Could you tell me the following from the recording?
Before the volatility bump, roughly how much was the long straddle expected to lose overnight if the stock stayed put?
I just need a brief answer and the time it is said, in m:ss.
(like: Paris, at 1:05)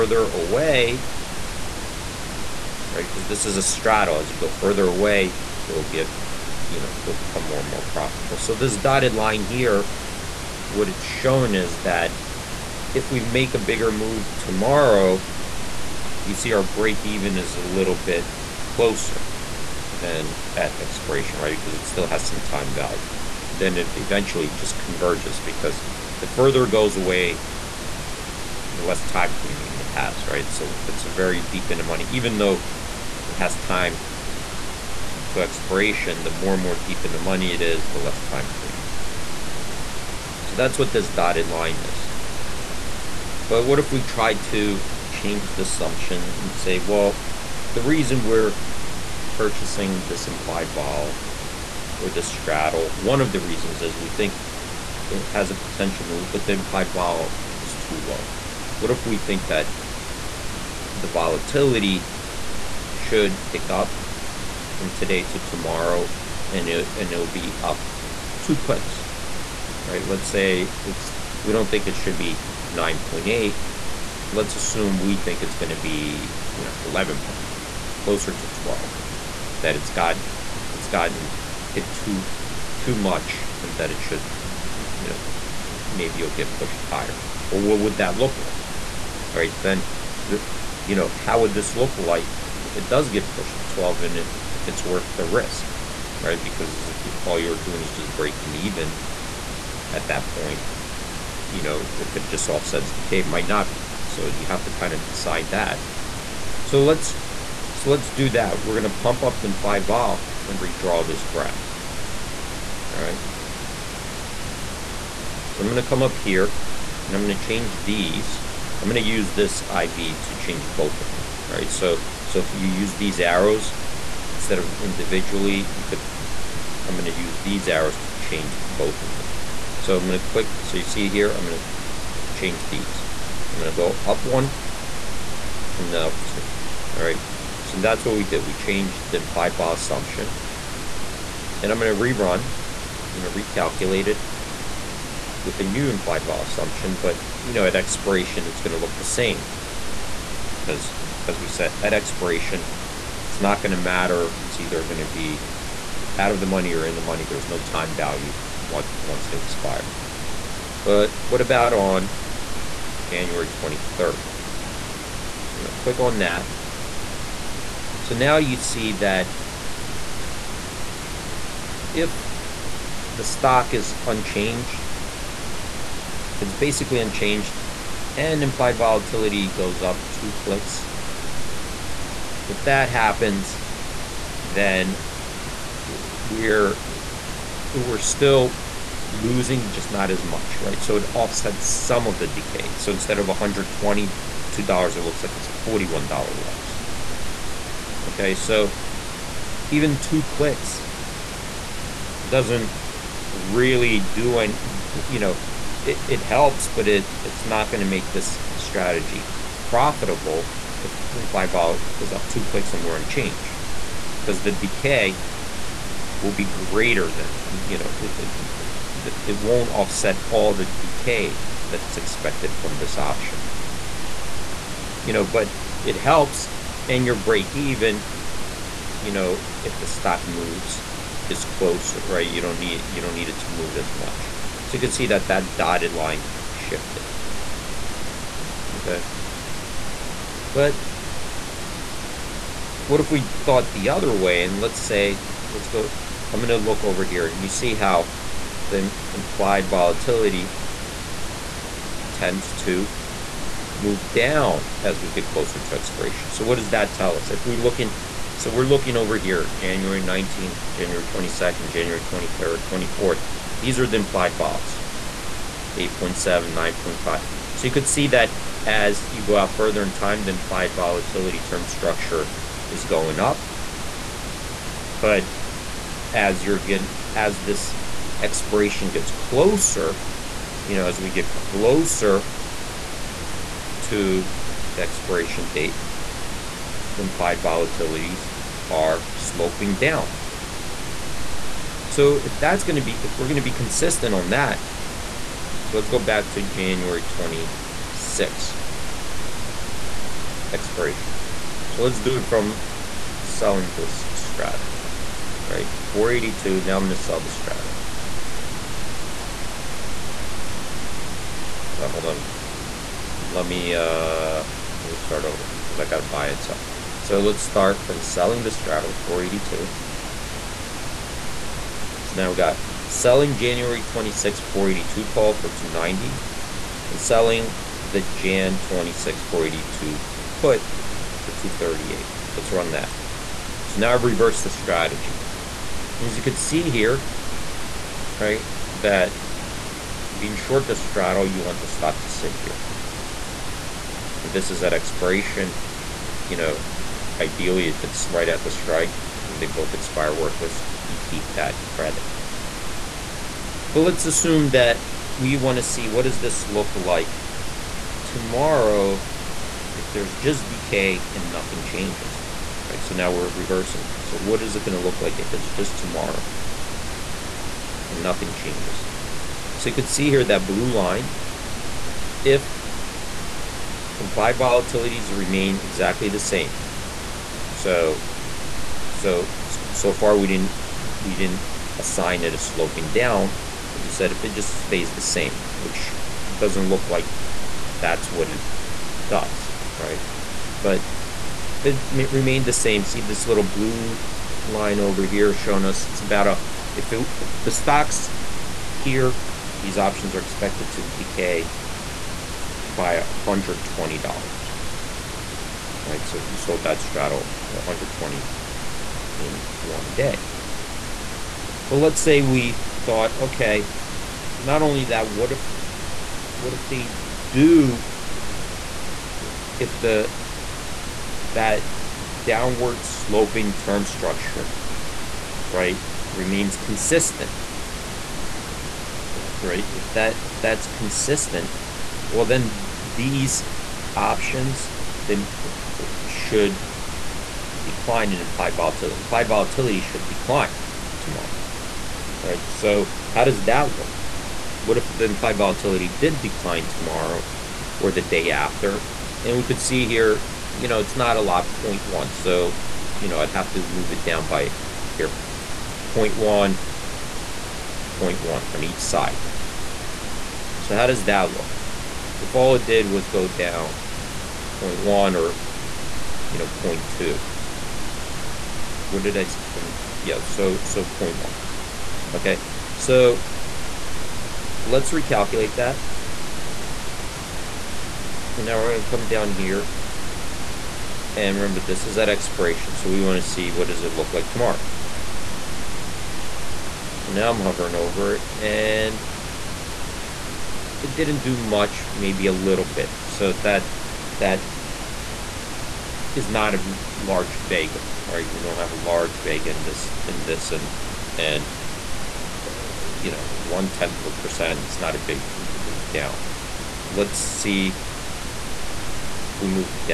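$122, at 3:13.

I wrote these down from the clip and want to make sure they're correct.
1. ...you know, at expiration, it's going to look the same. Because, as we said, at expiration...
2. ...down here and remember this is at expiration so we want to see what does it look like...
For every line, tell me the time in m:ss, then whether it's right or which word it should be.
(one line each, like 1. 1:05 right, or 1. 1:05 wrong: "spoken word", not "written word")
1. 2:27 right
2. 7:59 right.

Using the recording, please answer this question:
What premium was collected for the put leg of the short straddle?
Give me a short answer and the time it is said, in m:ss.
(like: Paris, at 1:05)
238, at 5:31.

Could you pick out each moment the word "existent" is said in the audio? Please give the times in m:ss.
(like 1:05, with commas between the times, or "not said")
not said.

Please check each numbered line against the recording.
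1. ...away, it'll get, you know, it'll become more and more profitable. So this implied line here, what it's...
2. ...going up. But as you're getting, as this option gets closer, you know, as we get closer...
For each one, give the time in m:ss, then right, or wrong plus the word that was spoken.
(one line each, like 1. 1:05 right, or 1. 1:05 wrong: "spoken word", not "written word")
1. 0:04 wrong: "dotted", not "implied"
2. 4:32 wrong: "expiration", not "option".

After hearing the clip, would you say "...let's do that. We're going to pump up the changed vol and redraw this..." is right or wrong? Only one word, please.
wrong.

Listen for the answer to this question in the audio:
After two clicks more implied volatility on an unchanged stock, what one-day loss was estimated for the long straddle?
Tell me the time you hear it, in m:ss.
3:15.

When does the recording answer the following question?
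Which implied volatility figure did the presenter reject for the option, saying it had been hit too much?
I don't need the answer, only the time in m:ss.
1:12.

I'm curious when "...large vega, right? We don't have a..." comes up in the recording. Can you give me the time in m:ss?
8:16.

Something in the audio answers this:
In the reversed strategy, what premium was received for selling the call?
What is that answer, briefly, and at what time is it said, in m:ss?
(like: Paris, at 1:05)
290, at 5:25.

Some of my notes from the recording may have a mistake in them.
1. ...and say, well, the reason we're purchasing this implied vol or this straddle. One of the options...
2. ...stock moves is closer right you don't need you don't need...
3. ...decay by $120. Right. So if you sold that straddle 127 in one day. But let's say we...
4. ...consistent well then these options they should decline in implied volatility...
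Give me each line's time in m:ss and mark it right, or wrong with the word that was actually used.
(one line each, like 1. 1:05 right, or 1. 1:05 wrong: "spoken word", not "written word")
1. 0:46 wrong: "reasons", not "options"
2. 3:49 right
3. 6:40 wrong: "120", not "127"
4. 7:10 right.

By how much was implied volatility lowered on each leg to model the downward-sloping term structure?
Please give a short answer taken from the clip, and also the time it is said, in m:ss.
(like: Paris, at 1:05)
0.1, at 7:35.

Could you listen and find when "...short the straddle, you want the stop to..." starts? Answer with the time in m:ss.
5:40.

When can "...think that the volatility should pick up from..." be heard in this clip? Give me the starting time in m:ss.
0:59.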